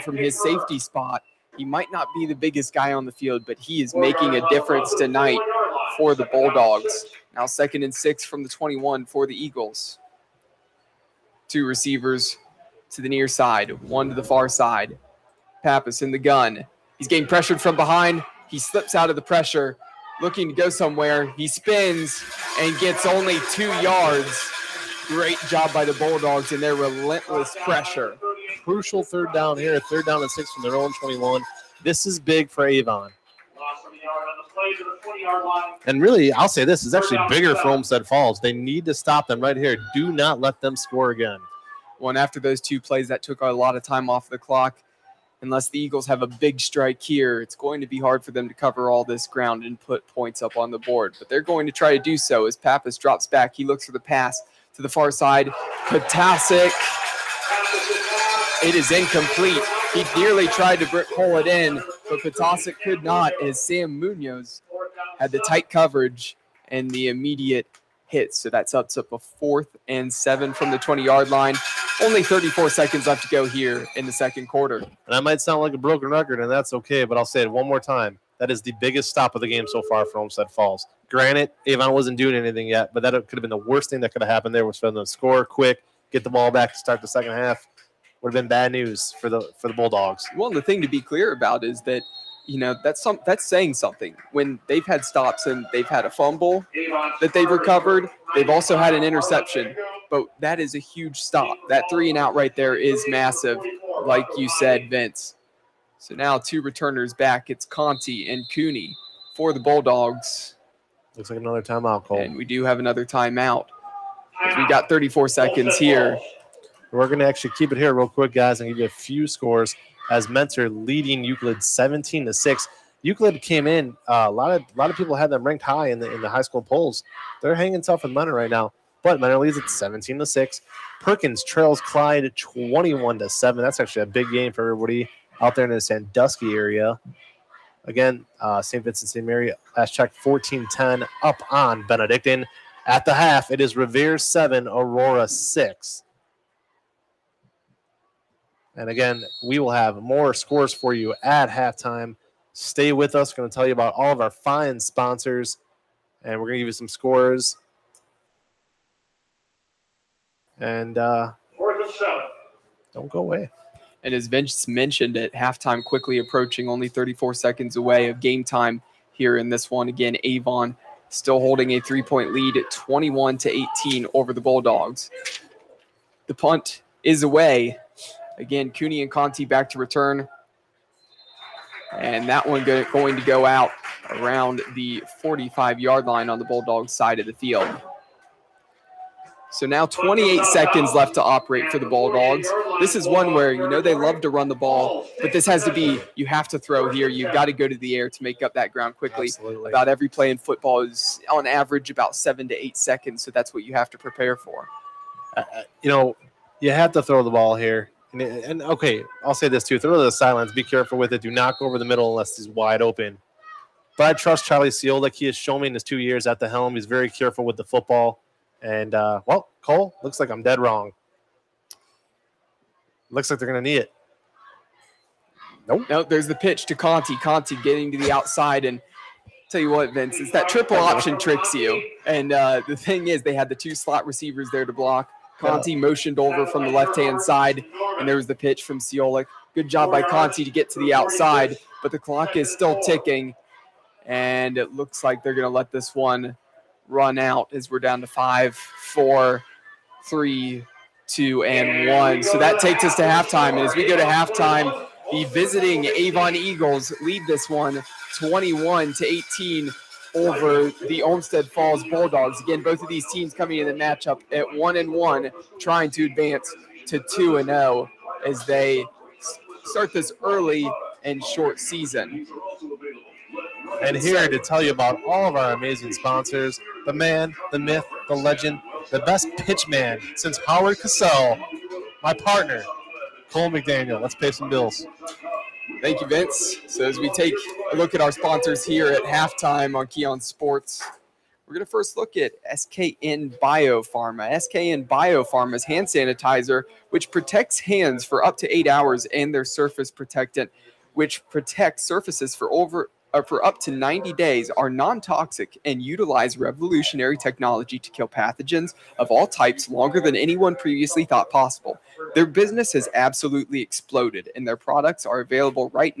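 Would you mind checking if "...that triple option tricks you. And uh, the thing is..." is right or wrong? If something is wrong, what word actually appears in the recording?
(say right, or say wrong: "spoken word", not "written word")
right.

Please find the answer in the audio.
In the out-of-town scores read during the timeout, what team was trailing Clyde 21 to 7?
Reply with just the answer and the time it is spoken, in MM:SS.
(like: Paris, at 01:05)
Perkins, at 02:10.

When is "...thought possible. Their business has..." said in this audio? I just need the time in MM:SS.
05:11.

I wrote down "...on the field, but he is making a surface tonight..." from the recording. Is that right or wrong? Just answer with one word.
wrong.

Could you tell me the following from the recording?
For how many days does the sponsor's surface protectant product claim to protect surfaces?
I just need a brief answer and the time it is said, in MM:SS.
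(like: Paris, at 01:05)
90, at 05:03.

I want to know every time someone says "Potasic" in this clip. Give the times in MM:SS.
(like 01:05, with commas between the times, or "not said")
00:55, 01:02.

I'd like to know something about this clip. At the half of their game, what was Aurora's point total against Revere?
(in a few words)
6.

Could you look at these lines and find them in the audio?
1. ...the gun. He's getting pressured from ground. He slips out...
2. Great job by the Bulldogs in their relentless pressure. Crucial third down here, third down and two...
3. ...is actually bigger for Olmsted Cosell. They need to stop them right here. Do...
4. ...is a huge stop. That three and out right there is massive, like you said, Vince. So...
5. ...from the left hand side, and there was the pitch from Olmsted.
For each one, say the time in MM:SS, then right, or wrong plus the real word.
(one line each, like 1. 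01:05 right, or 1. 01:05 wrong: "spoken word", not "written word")
1. 00:16 wrong: "behind", not "ground"
2. 00:25 wrong: "six", not "two"
3. 00:36 wrong: "Falls", not "Cosell"
4. 01:40 right
5. 03:56 wrong: "Siolik", not "Olmsted".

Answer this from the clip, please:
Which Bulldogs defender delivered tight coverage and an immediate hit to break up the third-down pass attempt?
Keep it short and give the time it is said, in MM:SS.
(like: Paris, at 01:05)
Sam Munoz, at 01:03.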